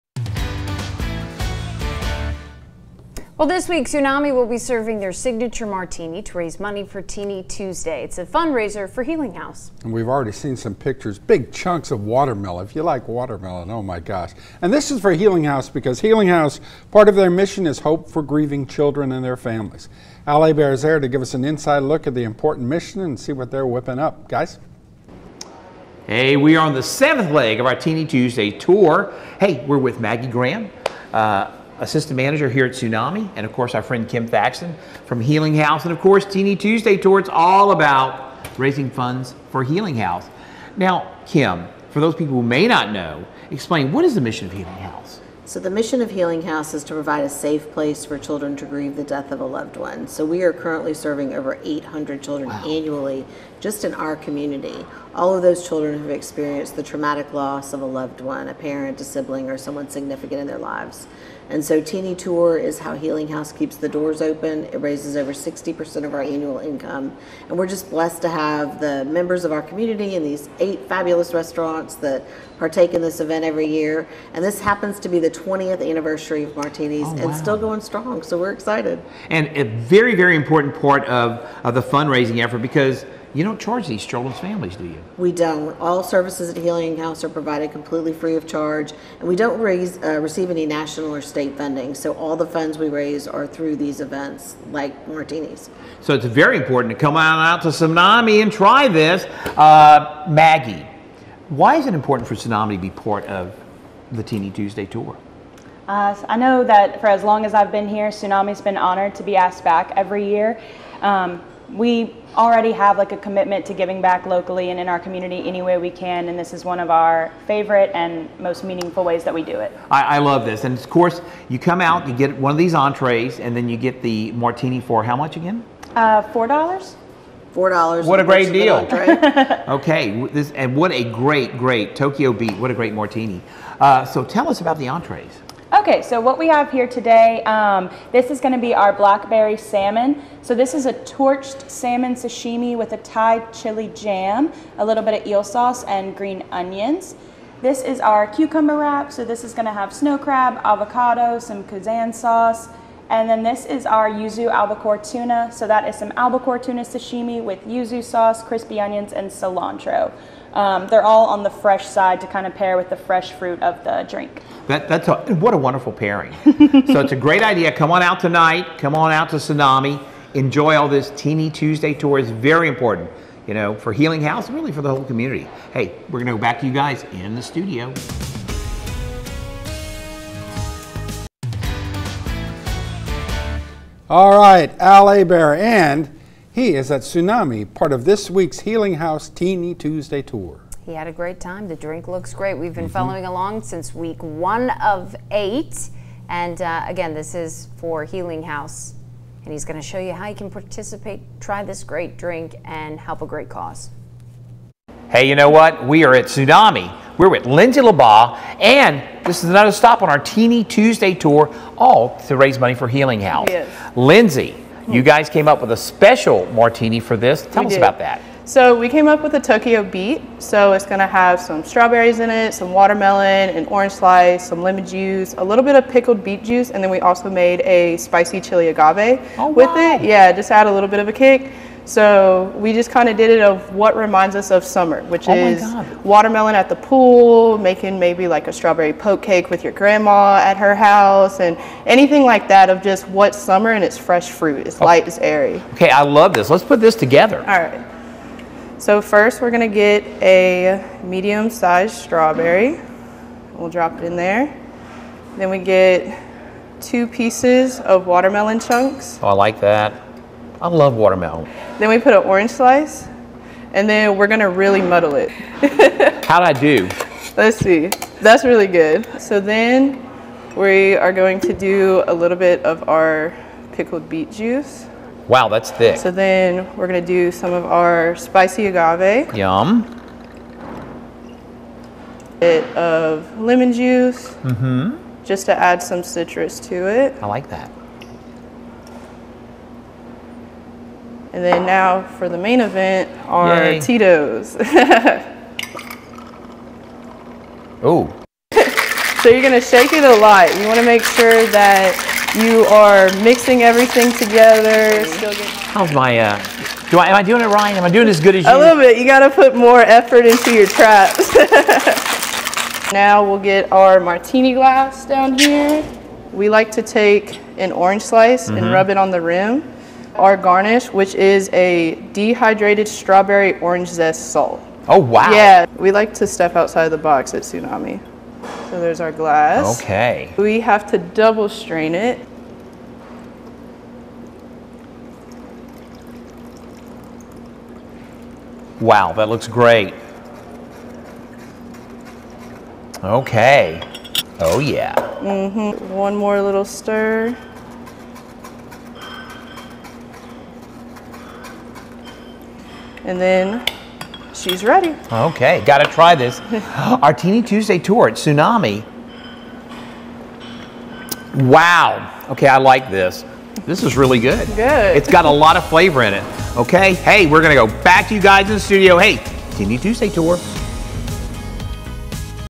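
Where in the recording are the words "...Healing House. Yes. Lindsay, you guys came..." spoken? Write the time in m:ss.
3:32.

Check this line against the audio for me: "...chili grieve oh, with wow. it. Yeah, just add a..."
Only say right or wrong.
wrong.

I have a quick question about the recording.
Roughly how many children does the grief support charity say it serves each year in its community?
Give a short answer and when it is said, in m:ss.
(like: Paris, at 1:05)
800, at 0:51.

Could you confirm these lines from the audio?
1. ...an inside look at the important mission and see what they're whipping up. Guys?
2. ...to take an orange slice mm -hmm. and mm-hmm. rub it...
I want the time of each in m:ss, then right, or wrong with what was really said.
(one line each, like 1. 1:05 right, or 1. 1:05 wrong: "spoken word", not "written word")
1. 0:21 right
2. 5:16 right.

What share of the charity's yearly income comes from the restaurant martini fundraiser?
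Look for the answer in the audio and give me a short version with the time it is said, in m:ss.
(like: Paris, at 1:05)
over 60%, at 1:05.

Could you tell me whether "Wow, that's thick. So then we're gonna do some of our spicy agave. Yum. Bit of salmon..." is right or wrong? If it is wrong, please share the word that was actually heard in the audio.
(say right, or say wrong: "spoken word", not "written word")
wrong: "lemon", not "salmon".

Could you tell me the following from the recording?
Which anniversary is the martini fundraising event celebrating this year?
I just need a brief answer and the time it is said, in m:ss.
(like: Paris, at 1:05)
20th, at 1:15.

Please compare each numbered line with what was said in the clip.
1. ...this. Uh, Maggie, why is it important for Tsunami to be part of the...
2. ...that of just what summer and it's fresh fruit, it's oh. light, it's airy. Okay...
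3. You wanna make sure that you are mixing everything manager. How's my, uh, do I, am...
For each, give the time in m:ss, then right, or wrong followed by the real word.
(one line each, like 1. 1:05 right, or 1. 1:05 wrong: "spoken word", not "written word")
1. 1:38 right
2. 4:02 right
3. 5:00 wrong: "together", not "manager".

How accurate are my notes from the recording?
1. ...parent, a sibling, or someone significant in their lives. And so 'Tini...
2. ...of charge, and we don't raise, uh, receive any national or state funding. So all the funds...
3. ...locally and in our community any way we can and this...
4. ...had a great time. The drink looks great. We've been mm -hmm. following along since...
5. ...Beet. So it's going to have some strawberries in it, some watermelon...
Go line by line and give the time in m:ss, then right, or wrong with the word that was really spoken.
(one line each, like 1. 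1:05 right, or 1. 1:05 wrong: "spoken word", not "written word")
1. 0:58 right
2. 1:28 right
3. 1:54 right
4. 3:10 right
5. 3:39 right.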